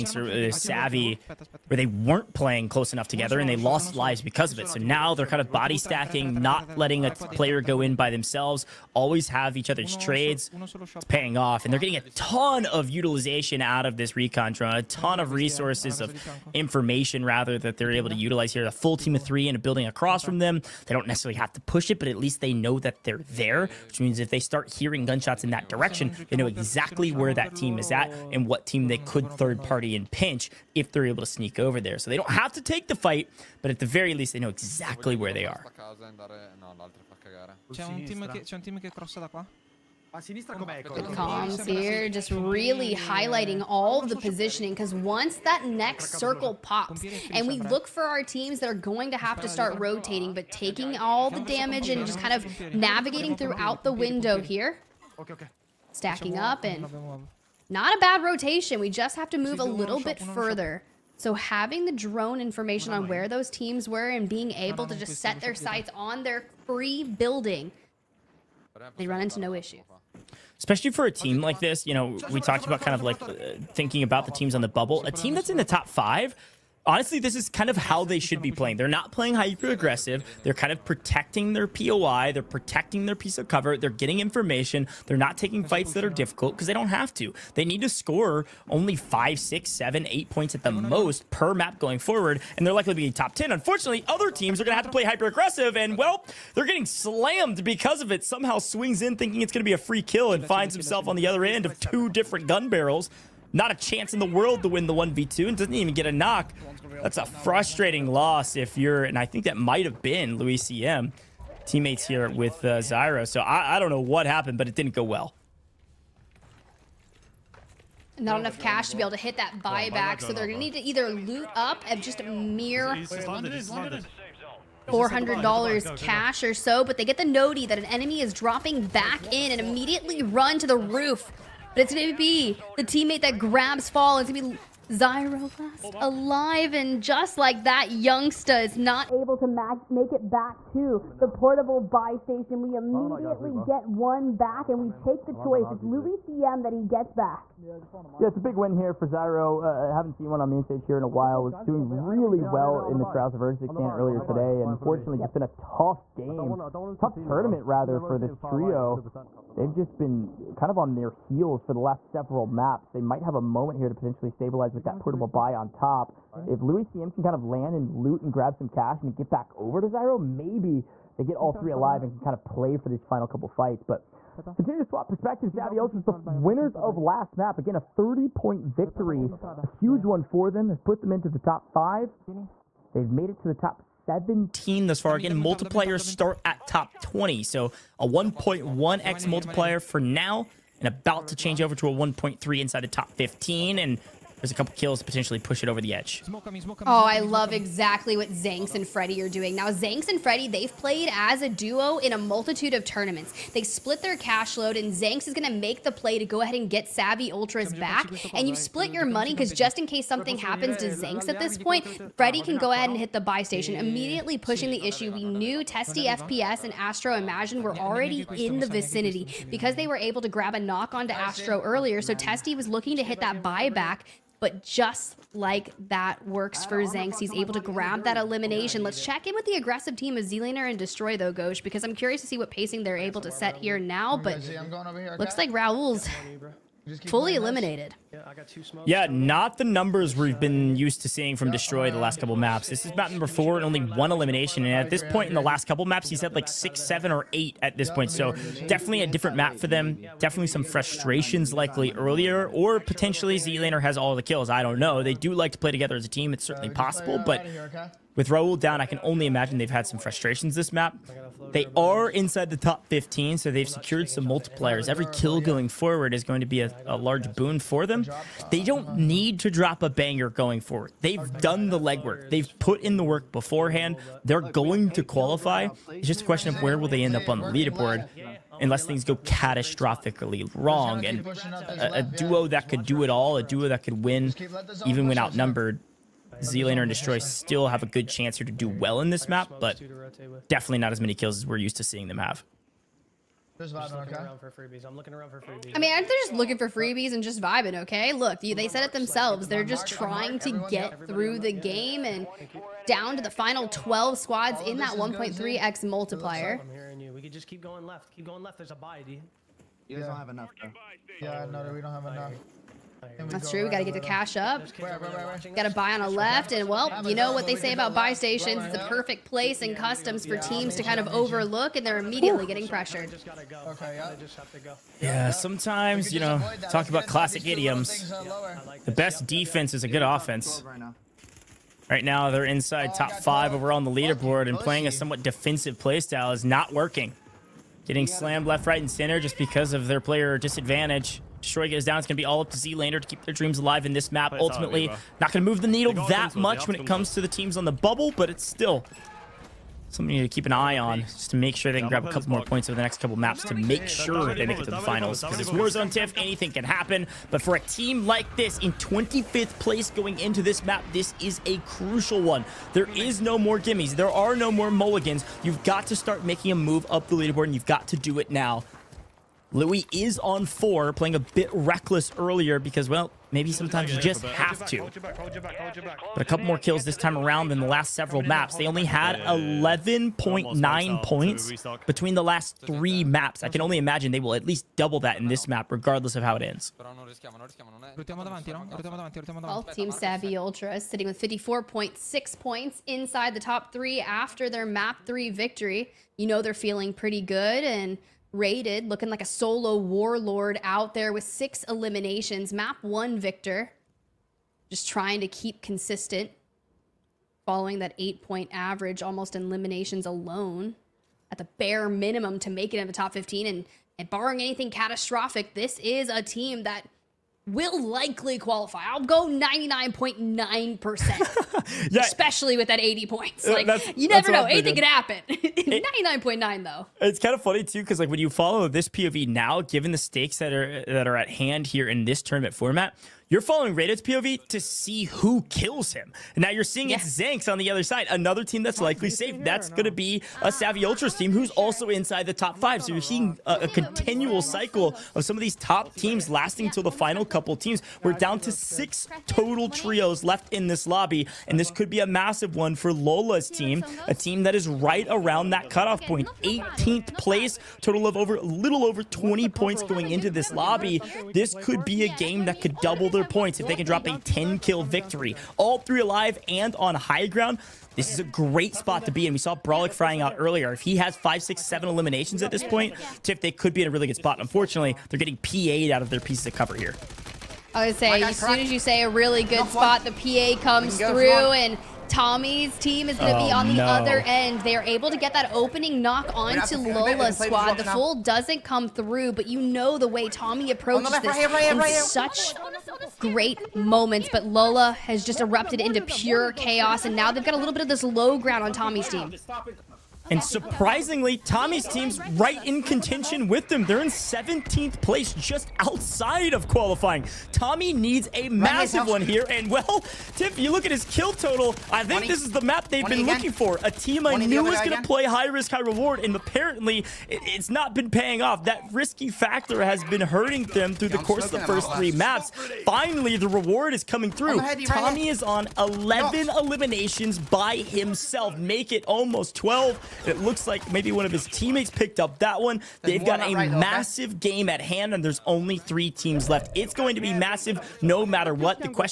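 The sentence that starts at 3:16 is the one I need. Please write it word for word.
Oh, I love exactly what Zanks and Freddy are doing.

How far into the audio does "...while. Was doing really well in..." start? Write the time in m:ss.
2:31.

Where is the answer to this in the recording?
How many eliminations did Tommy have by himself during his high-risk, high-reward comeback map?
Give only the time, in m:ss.
8:45.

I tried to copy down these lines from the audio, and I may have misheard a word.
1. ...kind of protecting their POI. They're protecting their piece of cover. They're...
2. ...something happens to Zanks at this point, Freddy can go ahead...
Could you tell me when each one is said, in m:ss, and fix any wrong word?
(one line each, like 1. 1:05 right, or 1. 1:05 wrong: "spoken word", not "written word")
1. 1:20 right
2. 3:30 right.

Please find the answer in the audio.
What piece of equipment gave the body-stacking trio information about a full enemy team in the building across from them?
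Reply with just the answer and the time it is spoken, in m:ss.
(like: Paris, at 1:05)
Recon drone, at 0:14.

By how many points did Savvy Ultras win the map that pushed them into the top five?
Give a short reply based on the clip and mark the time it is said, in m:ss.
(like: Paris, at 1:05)
30 points, at 2:57.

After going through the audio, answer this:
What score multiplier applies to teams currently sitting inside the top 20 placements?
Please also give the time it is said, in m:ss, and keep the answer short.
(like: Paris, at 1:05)
1.1x, at 3:08.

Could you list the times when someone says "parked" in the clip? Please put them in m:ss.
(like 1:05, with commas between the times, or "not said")
not said.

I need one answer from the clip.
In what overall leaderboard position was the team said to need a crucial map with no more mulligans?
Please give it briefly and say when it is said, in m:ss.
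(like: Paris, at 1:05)
25th place, at 5:58.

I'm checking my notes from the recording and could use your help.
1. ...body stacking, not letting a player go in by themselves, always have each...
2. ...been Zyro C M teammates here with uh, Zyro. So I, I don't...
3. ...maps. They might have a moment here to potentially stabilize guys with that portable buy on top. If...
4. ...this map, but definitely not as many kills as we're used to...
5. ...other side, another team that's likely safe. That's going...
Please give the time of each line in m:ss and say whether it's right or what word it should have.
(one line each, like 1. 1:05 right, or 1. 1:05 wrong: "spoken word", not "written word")
1. 0:05 right
2. 1:50 wrong: "Luis", not "Zyro"
3. 2:42 right
4. 4:49 right
5. 7:17 right.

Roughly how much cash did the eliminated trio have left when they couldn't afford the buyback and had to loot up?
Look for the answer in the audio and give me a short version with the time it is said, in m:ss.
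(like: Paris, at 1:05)
$400, at 2:02.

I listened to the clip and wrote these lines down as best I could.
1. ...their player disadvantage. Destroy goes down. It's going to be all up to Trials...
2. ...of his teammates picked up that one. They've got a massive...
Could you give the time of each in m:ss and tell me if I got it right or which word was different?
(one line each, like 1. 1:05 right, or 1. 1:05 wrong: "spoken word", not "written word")
1. 5:39 wrong: "Zlaner", not "Trials"
2. 8:51 right.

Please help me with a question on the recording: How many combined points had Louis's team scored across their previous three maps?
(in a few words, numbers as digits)
11.9.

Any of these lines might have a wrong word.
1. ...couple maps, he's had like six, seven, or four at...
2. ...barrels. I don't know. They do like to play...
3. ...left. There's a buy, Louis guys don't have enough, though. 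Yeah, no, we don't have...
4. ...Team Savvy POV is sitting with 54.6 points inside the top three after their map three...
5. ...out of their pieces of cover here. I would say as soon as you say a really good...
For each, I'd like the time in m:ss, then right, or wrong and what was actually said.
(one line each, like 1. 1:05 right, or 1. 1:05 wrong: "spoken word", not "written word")
1. 4:05 wrong: "eight", not "four"
2. 4:14 wrong: "kills", not "barrels"
3. 5:08 wrong: "You", not "Louis"
4. 6:29 wrong: "Ultra", not "POV"
5. 7:55 right.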